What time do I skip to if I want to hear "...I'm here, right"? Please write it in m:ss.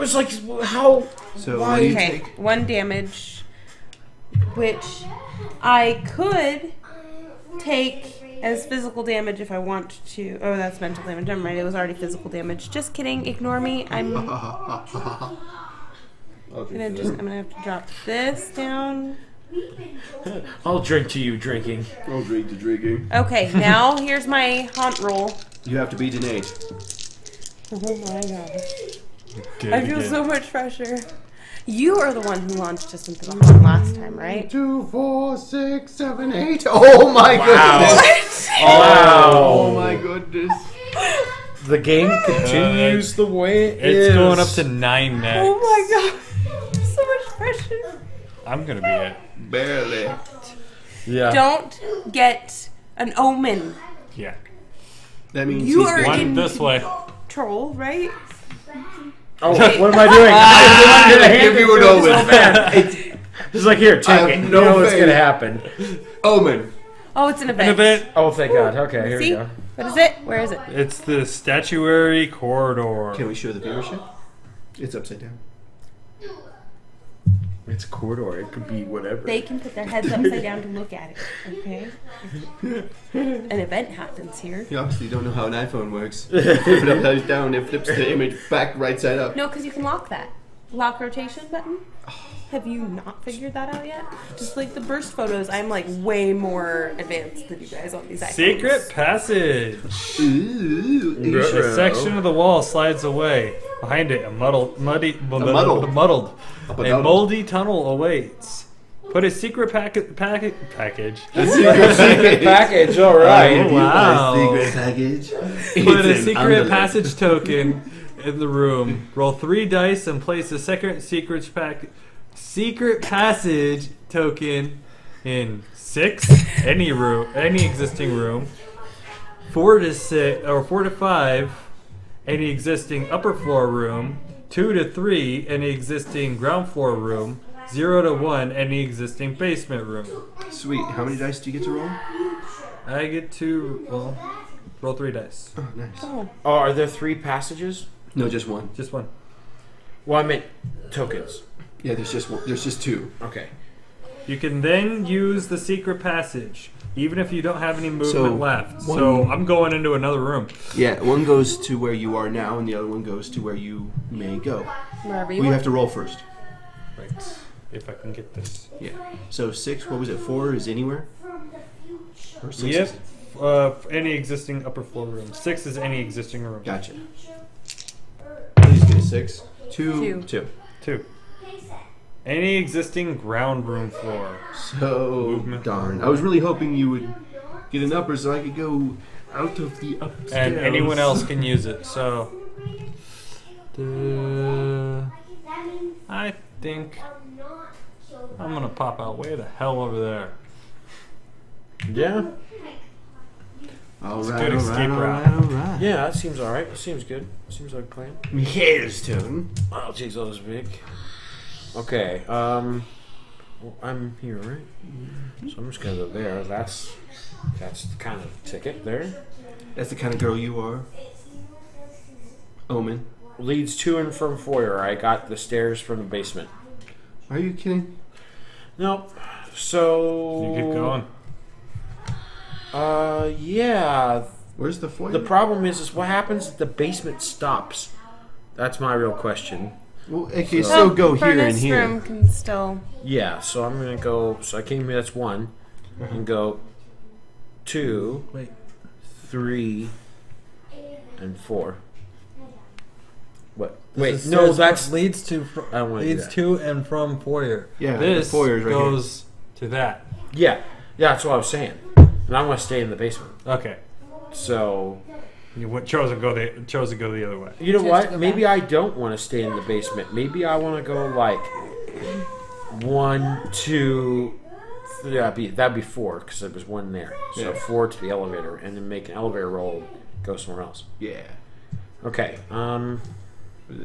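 3:33.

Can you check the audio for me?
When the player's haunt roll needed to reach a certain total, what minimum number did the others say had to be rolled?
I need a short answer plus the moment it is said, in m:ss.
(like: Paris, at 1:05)
8, at 0:25.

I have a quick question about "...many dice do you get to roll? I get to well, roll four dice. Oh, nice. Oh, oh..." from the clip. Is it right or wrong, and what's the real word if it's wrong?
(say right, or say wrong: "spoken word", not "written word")
wrong: "three", not "four".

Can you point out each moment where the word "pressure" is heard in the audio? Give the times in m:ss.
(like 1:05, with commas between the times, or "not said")
0:30, 0:47.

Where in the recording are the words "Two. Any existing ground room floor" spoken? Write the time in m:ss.
3:00.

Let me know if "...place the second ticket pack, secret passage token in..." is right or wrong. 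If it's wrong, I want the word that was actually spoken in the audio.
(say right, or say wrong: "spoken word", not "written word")
wrong: "secret", not "ticket".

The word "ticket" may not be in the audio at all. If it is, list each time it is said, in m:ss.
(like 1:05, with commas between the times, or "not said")
3:38.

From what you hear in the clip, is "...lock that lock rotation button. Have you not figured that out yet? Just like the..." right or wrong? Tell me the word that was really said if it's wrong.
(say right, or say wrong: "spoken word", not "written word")
right.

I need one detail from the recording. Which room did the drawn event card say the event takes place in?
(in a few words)
Statuary corridor.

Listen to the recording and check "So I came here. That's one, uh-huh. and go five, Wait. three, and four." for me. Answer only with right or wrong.
wrong.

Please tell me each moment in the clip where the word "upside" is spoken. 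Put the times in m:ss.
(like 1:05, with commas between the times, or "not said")
1:14, 1:20, 1:26.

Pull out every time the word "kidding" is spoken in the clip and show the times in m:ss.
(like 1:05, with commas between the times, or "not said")
0:12, 3:47.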